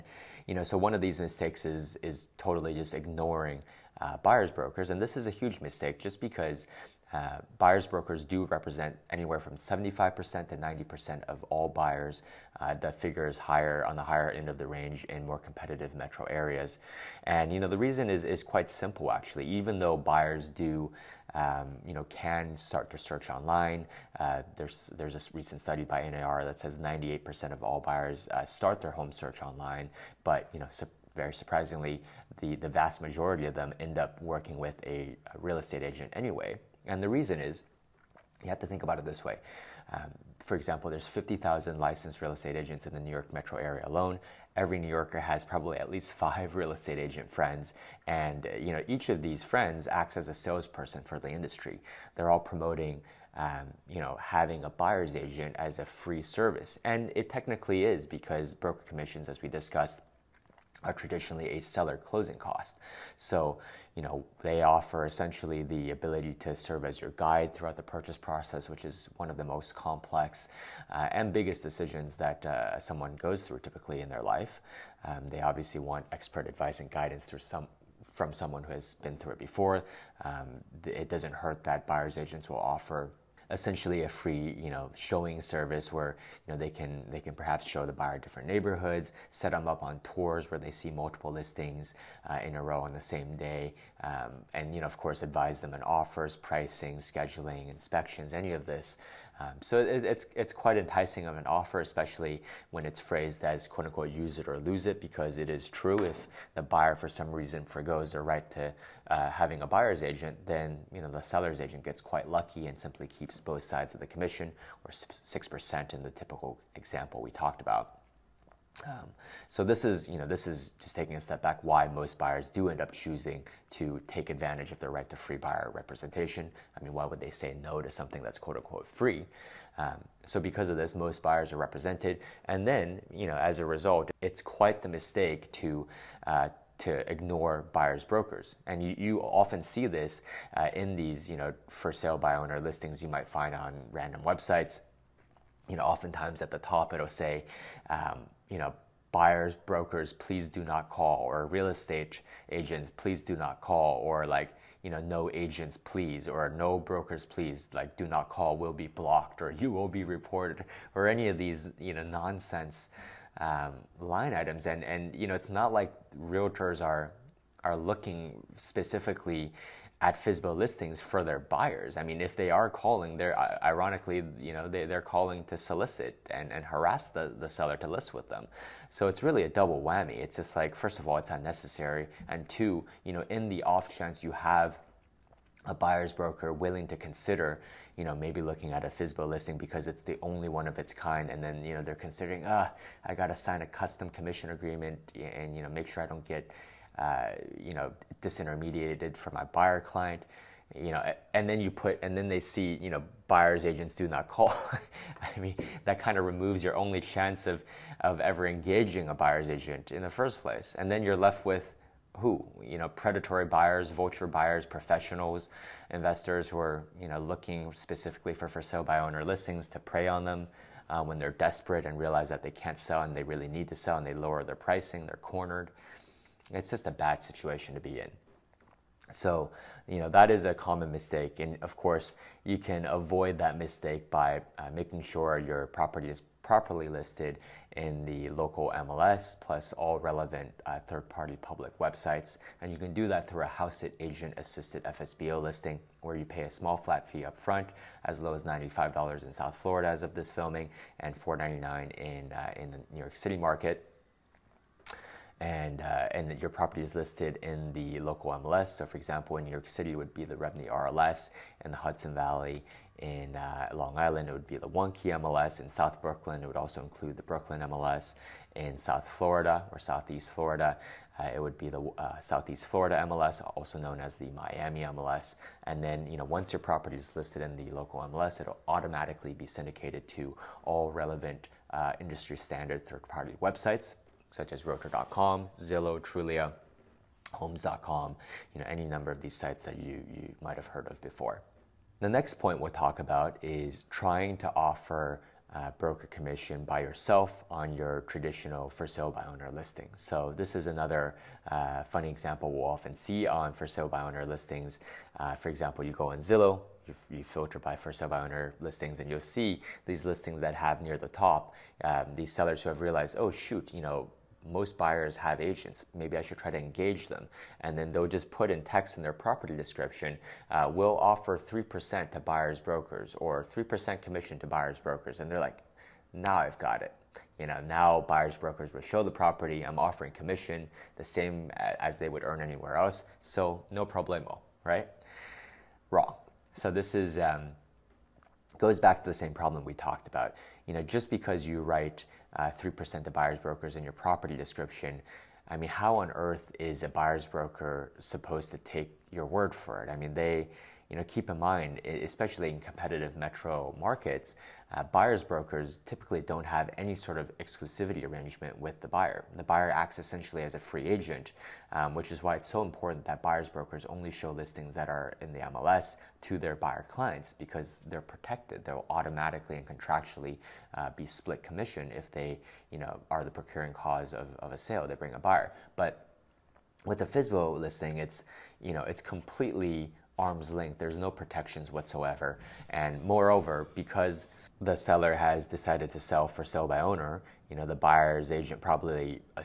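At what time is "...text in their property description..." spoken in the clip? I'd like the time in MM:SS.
05:18.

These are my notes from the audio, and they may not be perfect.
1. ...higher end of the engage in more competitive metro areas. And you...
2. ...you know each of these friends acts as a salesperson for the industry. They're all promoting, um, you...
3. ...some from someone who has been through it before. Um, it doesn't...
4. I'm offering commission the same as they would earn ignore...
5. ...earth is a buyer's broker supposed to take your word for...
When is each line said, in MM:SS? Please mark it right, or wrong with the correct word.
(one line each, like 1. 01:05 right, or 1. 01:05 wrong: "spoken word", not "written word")
1. 00:14 wrong: "range", not "engage"
2. 00:48 right
3. 01:17 right
4. 05:29 wrong: "anywhere", not "ignore"
5. 05:46 right.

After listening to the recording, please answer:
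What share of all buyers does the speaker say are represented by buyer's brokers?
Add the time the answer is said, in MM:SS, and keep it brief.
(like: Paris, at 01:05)
75% to 90%, at 00:09.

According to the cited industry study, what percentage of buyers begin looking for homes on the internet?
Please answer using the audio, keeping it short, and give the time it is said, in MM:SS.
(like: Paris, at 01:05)
98%, at 00:26.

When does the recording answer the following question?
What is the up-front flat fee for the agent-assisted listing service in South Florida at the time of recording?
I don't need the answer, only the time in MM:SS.
04:08.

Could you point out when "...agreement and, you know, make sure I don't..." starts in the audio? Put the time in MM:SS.
03:14.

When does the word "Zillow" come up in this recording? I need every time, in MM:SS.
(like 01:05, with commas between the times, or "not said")
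04:45, 05:06.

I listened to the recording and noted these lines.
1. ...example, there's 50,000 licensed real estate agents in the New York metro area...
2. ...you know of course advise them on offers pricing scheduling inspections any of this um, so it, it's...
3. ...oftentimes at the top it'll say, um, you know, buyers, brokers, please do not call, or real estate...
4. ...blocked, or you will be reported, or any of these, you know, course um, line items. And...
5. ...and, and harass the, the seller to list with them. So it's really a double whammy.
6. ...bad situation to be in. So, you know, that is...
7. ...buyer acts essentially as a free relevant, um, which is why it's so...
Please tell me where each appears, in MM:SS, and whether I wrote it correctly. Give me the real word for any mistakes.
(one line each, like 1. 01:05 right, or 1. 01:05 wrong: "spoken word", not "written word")
1. 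00:40 right
2. 01:34 right
3. 02:25 right
4. 02:38 wrong: "nonsense", not "course"
5. 02:56 right
6. 03:46 right
7. 05:59 wrong: "agent", not "relevant".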